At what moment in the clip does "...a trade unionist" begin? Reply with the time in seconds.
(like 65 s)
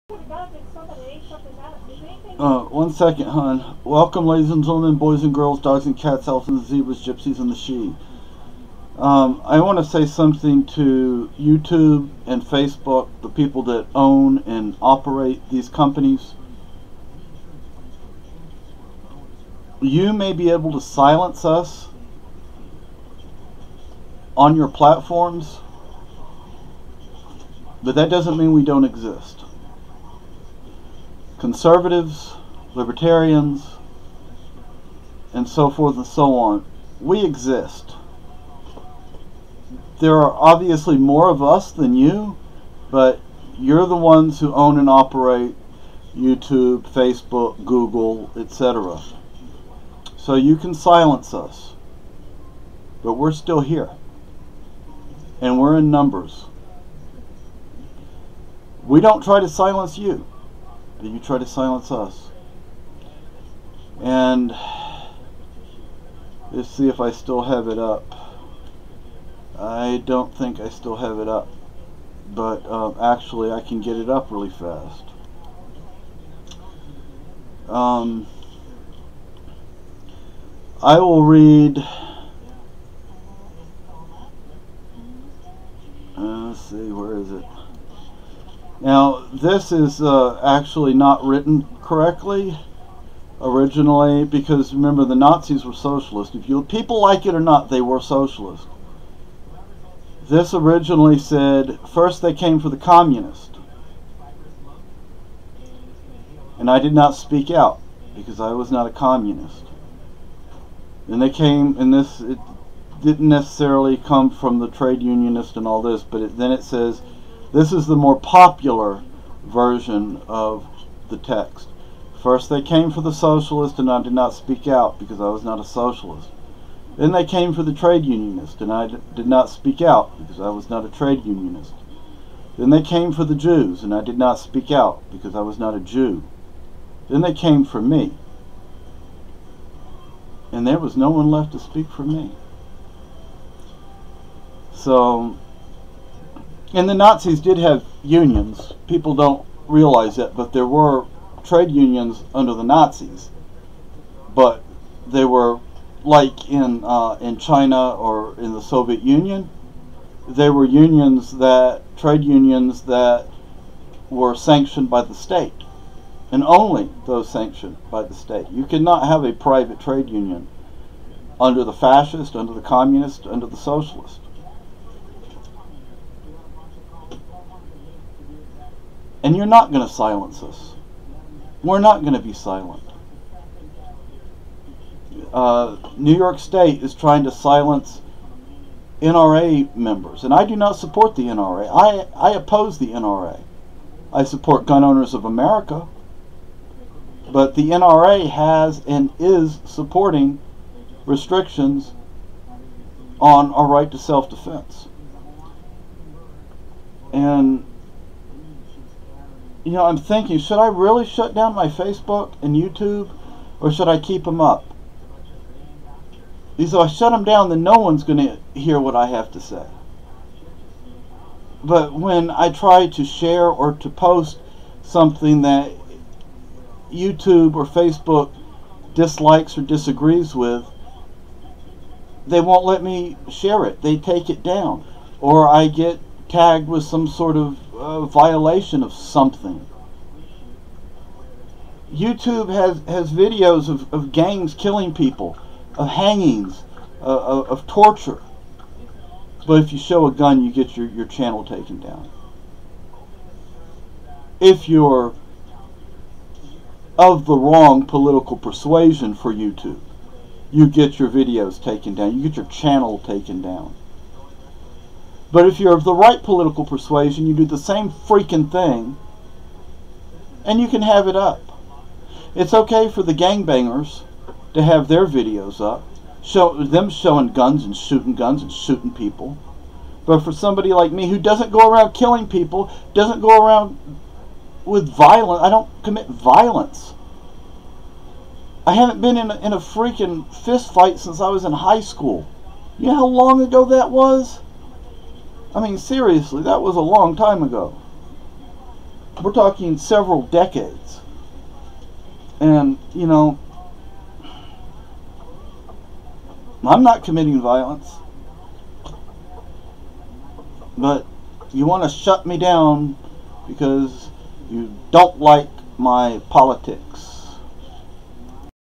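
130 s.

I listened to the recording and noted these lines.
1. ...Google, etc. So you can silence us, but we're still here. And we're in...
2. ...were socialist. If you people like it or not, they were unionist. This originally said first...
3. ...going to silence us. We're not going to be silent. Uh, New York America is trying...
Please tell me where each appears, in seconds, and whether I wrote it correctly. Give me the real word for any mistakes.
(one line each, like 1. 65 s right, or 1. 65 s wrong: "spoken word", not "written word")
1. 47 s right
2. 95 s wrong: "socialist", not "unionist"
3. 179 s wrong: "State", not "America".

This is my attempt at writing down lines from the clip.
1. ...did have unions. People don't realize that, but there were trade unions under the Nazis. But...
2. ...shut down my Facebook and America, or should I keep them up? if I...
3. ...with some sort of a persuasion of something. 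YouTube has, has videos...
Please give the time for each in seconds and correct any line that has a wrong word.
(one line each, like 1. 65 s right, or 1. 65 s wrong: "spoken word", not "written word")
1. 147 s right
2. 211 s wrong: "YouTube", not "America"
3. 236 s wrong: "violation", not "persuasion".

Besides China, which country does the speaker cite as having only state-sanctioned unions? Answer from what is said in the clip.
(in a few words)
Soviet Union.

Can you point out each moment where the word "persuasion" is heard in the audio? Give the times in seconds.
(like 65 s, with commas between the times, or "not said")
258 s, 266 s.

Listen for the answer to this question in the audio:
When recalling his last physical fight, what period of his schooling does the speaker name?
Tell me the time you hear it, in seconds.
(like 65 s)
291 s.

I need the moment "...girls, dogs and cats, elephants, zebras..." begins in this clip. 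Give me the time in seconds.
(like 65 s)
5 s.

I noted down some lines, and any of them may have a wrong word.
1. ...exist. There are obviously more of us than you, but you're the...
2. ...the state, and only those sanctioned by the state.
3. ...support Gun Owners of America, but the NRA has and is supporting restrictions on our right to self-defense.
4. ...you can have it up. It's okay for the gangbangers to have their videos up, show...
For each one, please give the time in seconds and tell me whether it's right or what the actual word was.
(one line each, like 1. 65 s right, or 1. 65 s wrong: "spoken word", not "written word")
1. 37 s right
2. 165 s right
3. 194 s right
4. 270 s right.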